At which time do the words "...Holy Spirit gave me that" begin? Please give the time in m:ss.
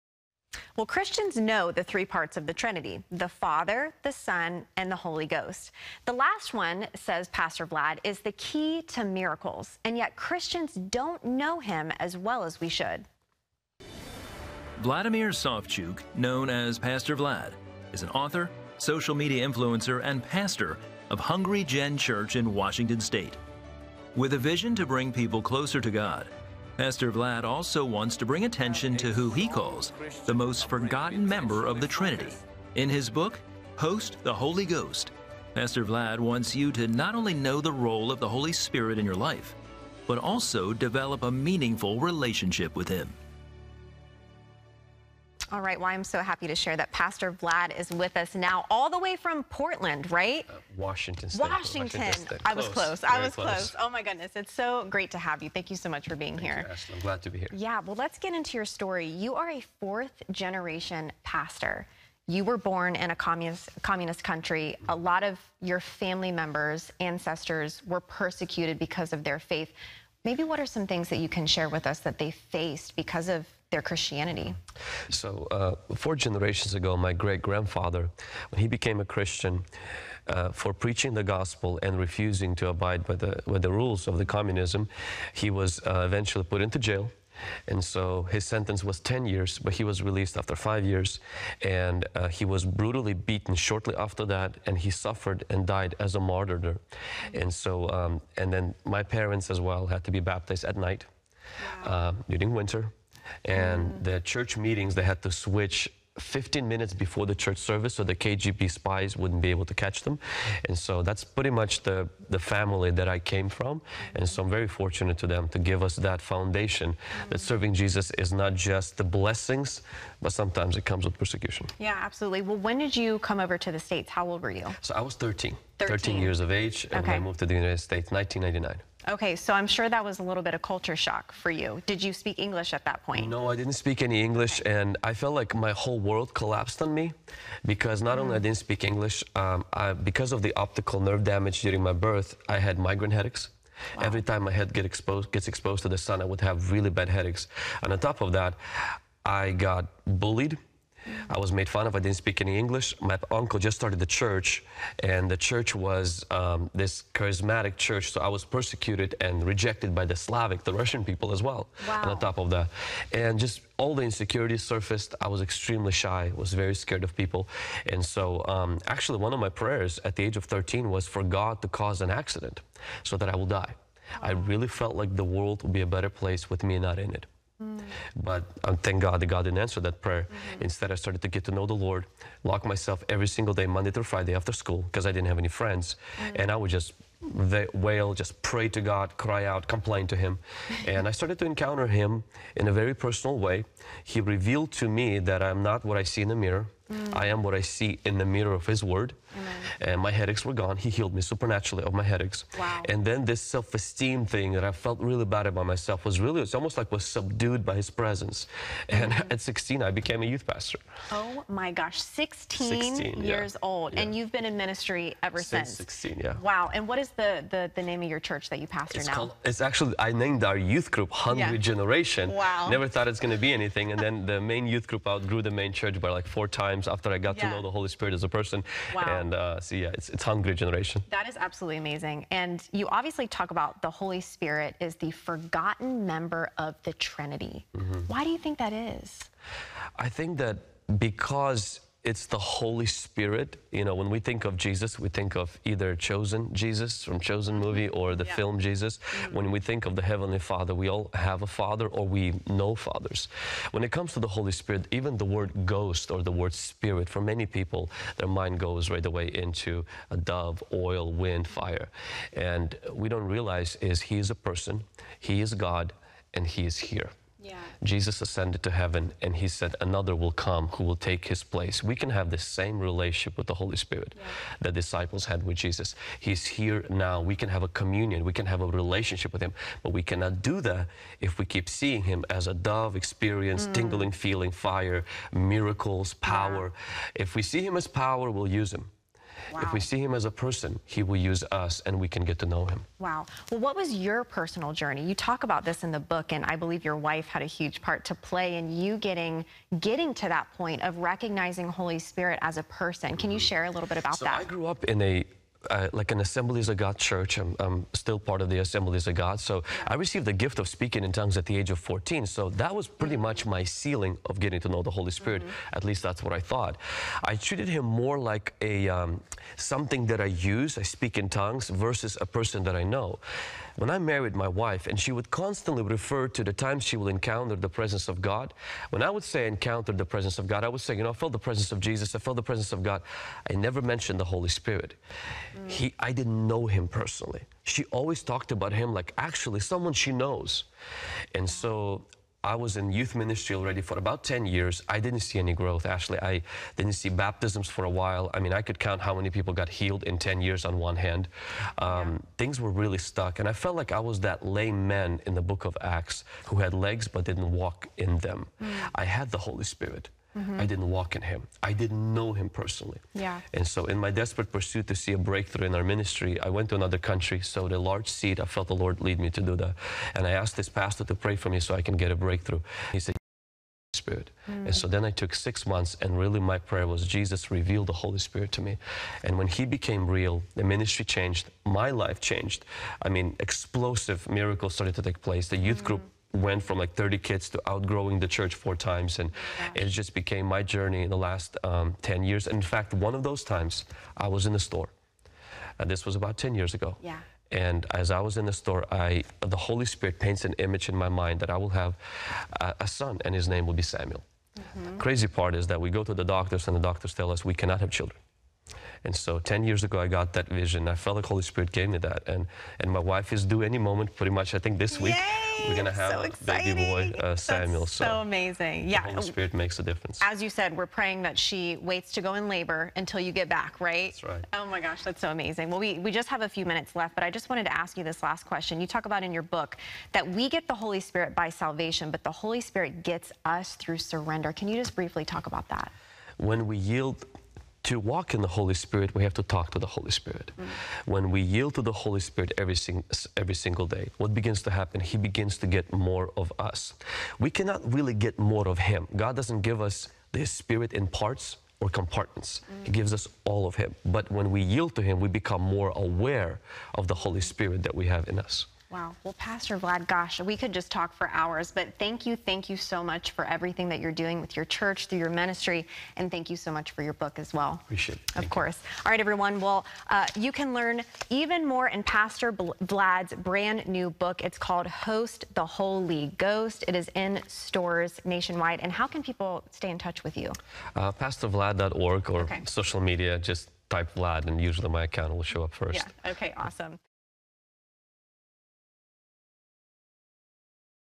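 6:51.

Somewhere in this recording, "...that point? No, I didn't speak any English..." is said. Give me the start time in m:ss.
2:12.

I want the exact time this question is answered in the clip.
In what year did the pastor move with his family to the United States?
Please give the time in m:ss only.
2:08.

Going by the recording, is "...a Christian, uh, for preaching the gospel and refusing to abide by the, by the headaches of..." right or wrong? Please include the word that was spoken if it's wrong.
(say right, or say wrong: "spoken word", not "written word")
wrong: "rules", not "headaches".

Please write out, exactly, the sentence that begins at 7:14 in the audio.
Can you just briefly talk about that?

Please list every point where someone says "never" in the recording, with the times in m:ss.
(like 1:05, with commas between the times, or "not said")
3:42, 5:33.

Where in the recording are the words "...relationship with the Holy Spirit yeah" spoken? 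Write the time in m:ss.
4:32.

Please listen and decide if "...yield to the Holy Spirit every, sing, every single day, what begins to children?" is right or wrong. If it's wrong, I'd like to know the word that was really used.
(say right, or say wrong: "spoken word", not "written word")
wrong: "happen", not "children".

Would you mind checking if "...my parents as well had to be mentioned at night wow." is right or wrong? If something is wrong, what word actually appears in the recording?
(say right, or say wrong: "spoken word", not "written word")
wrong: "baptized", not "mentioned".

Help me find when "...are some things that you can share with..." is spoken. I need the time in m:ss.
1:10.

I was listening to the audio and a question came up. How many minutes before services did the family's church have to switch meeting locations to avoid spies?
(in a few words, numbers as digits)
15 minutes.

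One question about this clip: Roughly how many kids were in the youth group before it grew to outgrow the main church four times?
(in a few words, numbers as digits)
30.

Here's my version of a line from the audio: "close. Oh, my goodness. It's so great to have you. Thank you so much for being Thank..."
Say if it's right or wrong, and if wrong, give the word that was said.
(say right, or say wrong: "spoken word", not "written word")
right.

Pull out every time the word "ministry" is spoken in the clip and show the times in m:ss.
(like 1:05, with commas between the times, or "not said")
3:34, 5:43, 6:05, 6:20, 7:45.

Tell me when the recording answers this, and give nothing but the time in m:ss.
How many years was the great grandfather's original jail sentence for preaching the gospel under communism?
1:28.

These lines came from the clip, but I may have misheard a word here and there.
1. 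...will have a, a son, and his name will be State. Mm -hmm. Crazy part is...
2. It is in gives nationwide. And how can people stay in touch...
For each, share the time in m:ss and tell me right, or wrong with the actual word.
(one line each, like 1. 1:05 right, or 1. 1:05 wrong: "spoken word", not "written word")
1. 6:41 wrong: "Samuel", not "State"
2. 7:56 wrong: "stores", not "gives".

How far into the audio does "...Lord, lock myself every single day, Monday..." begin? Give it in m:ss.
3:01.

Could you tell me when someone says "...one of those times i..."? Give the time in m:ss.
6:32.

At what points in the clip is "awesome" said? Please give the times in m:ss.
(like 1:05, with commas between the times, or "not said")
8:06.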